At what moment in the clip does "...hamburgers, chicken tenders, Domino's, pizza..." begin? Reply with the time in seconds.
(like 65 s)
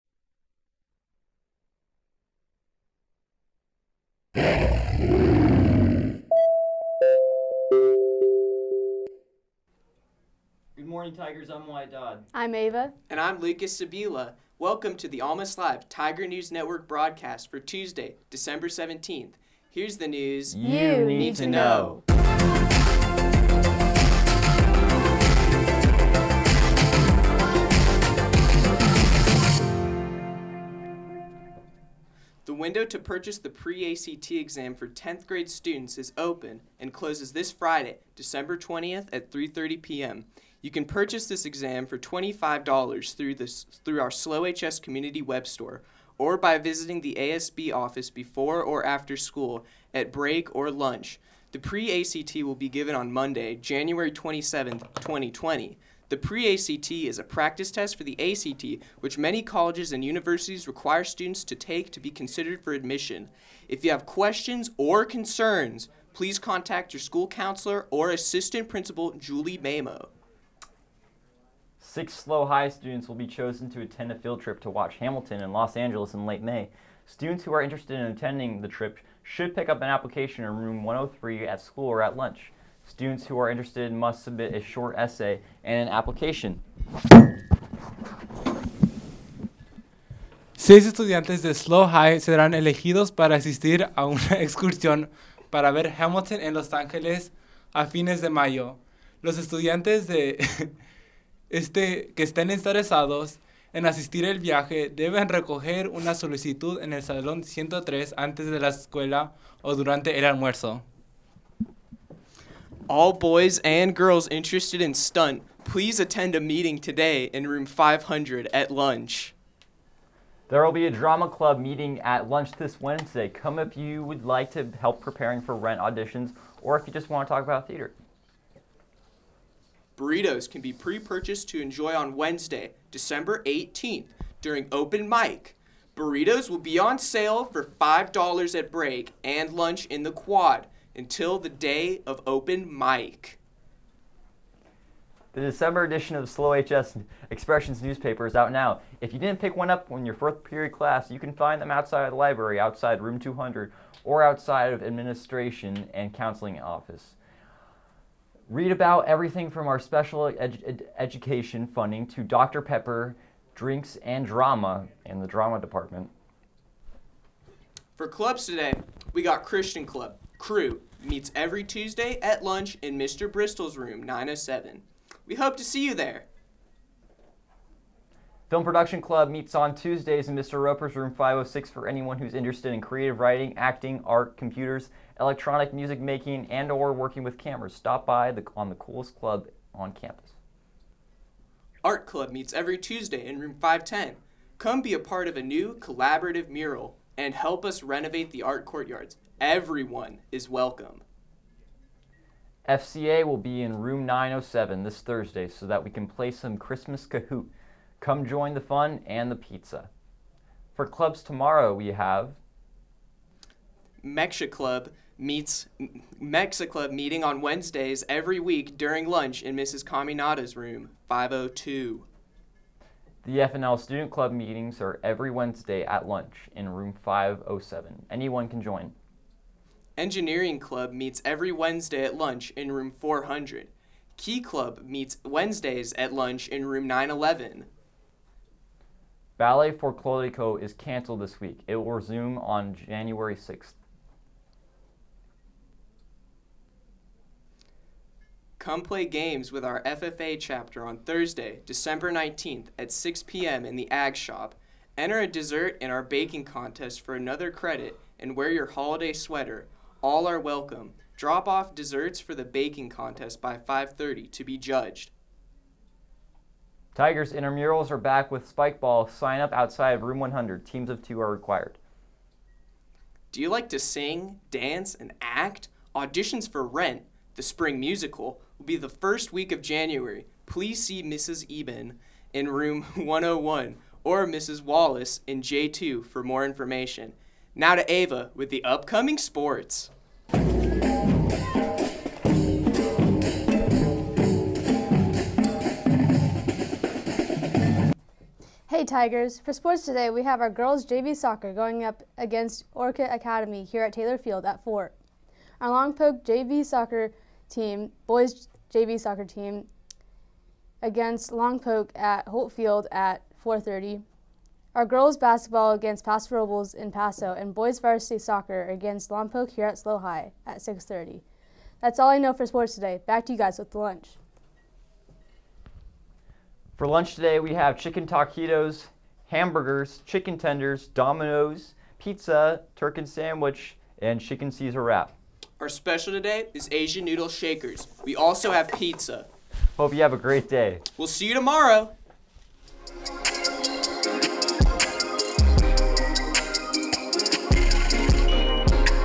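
329 s.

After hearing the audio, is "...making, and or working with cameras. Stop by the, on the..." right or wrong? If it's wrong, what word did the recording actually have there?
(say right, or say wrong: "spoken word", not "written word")
right.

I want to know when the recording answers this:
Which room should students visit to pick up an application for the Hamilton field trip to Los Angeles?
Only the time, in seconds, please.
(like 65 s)
80 s.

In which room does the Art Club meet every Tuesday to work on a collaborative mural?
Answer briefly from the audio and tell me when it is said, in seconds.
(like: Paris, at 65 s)
510, at 193 s.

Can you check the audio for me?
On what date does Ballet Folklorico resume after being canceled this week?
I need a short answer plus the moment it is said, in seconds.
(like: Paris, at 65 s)
January 6th, at 242 s.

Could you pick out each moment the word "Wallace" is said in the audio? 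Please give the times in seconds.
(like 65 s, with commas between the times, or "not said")
284 s.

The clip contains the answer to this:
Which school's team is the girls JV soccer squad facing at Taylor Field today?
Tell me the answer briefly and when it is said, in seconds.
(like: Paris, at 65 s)
Orcutt Academy, at 302 s.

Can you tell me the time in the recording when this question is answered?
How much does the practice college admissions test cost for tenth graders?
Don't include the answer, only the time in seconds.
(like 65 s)
41 s.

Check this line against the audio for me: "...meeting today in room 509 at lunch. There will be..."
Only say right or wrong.
wrong.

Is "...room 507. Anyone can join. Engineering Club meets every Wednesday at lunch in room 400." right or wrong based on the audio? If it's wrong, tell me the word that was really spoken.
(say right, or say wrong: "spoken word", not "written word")
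right.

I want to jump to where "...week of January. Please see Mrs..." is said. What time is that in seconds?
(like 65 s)
279 s.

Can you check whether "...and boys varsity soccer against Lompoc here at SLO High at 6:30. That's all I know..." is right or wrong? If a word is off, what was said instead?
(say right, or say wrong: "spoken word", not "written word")
right.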